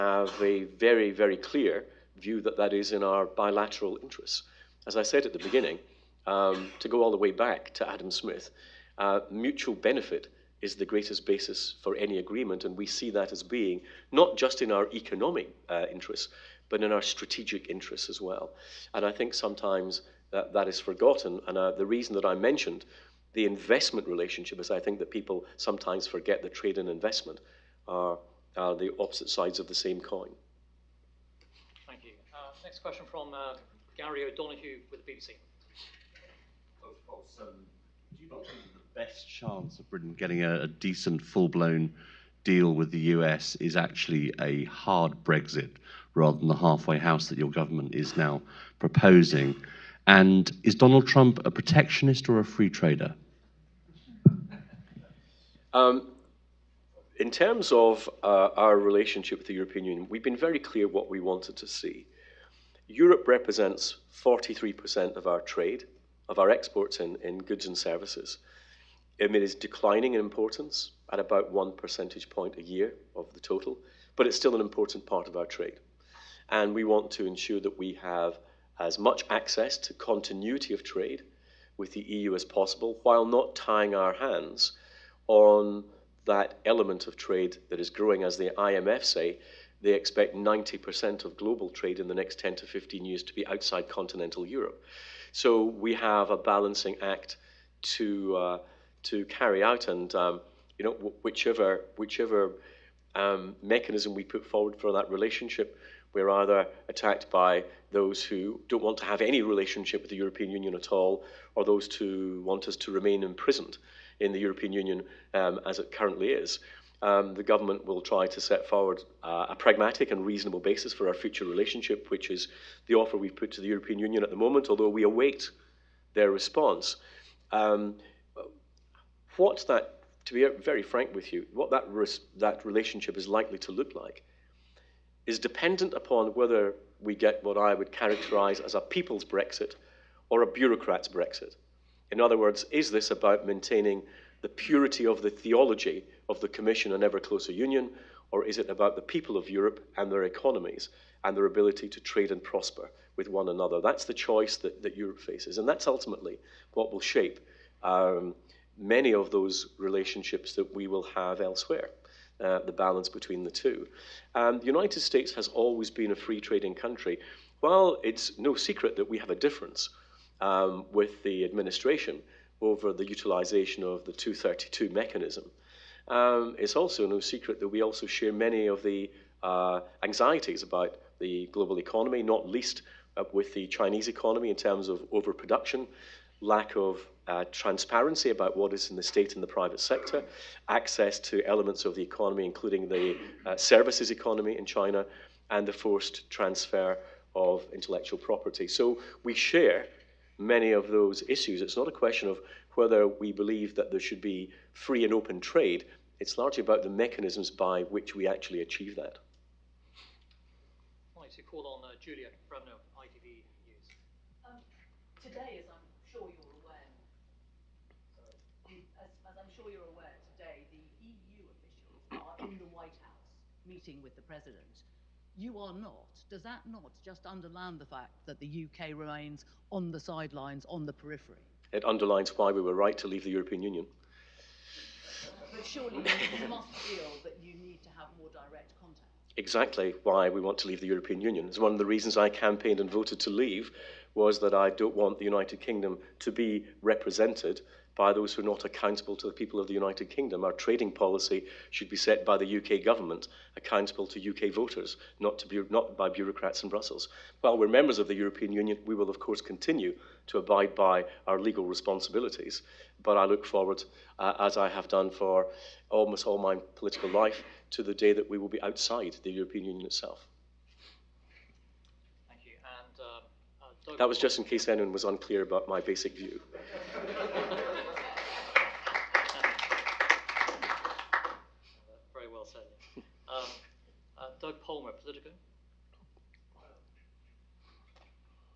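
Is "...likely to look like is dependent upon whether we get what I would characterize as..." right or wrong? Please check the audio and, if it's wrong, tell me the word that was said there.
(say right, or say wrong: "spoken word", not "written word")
right.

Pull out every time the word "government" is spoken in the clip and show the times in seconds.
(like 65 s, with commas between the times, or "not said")
47 s, 117 s, 252 s.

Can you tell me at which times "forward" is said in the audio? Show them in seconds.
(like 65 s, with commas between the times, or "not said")
104 s, 118 s, 263 s.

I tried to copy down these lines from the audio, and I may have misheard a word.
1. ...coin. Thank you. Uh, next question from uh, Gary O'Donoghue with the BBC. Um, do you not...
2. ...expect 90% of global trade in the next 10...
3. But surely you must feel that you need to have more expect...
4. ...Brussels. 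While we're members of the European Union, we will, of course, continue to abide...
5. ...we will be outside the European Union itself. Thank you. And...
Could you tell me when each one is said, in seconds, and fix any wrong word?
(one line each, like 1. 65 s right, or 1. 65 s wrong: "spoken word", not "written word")
1. 30 s right
2. 89 s right
3. 235 s wrong: "direct", not "expect"
4. 256 s right
5. 268 s right.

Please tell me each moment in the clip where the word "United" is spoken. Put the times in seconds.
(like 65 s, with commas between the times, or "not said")
164 s, 245 s, 249 s.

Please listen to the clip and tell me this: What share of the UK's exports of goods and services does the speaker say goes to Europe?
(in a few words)
43%.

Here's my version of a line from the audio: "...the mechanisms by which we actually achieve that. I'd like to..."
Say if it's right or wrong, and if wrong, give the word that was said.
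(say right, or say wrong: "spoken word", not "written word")
right.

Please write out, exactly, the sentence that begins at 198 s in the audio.
So we share many of those issues.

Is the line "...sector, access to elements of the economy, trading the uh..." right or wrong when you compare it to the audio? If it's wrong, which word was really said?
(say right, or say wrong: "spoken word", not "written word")
wrong: "including", not "trading".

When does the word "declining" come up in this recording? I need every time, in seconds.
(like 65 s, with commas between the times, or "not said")
69 s.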